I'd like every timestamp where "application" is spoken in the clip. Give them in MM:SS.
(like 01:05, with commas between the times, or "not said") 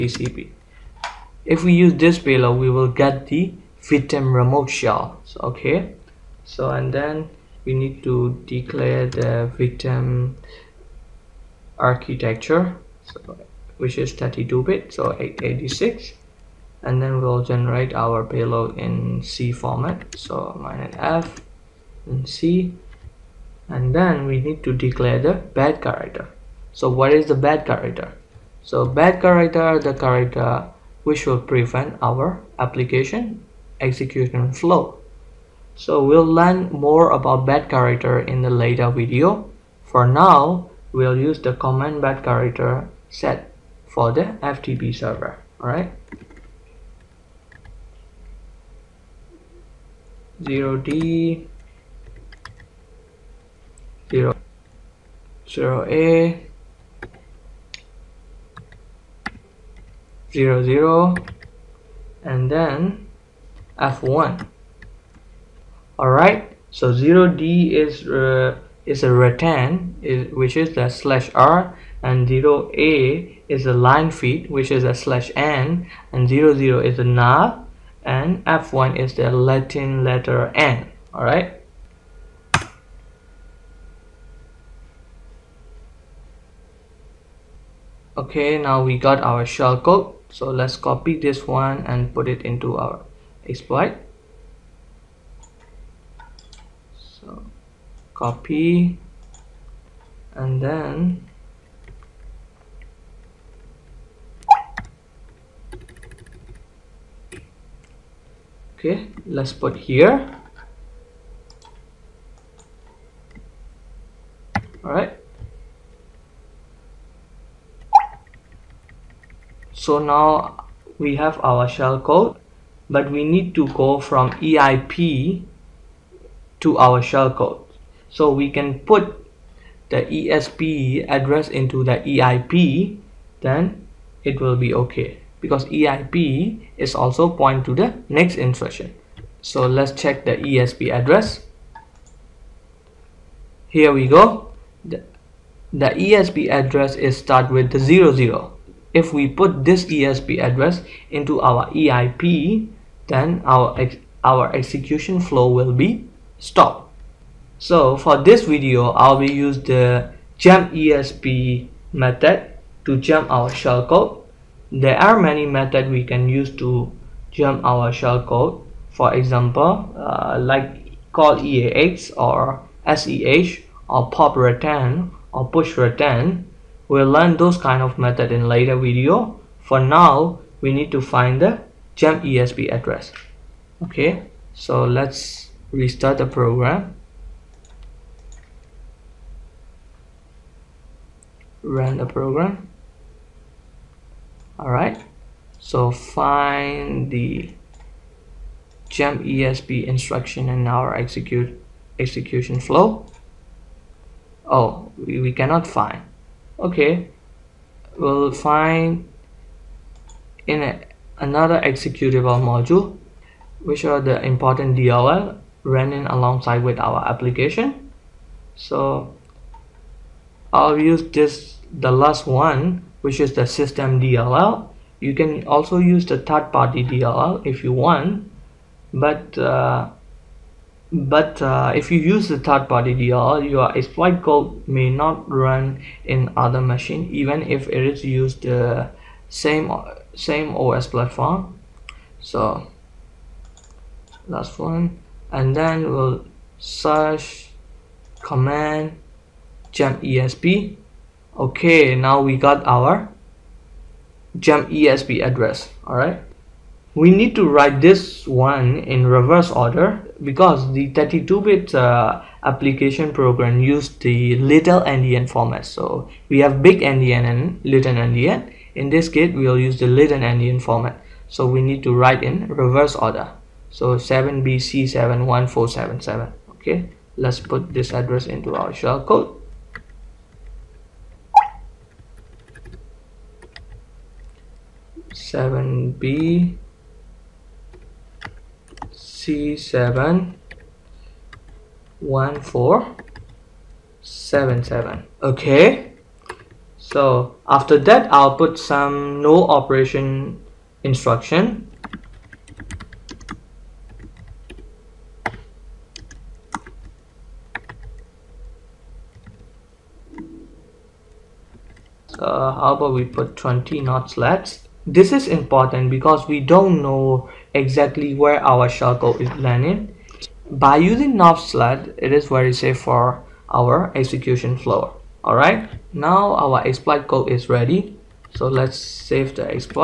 00:32, 03:37, 04:22.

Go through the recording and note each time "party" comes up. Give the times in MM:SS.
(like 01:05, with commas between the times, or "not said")
03:46, 03:52.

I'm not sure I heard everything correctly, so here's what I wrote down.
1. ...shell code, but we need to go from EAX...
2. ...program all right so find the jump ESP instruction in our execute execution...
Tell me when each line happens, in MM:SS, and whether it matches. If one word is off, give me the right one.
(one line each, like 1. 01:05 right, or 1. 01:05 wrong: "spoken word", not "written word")
1. 02:01 wrong: "EIP", not "EAX"
2. 03:12 right.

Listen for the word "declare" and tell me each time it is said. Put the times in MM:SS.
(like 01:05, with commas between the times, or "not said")
00:08, 00:24.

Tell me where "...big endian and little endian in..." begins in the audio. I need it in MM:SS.
04:26.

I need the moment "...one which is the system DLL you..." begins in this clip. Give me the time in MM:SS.
03:42.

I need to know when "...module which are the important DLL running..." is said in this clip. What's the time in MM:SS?
03:32.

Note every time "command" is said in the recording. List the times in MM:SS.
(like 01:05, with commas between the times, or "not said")
00:41, 04:08.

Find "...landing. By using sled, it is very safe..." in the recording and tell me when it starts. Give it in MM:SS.
05:19.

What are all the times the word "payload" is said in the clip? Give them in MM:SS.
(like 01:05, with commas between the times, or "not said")
00:02, 00:18.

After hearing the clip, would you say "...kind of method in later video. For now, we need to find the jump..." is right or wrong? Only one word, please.
right.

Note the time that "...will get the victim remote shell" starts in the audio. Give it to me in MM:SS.
00:02.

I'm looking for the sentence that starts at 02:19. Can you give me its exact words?
So let's check the ESP address.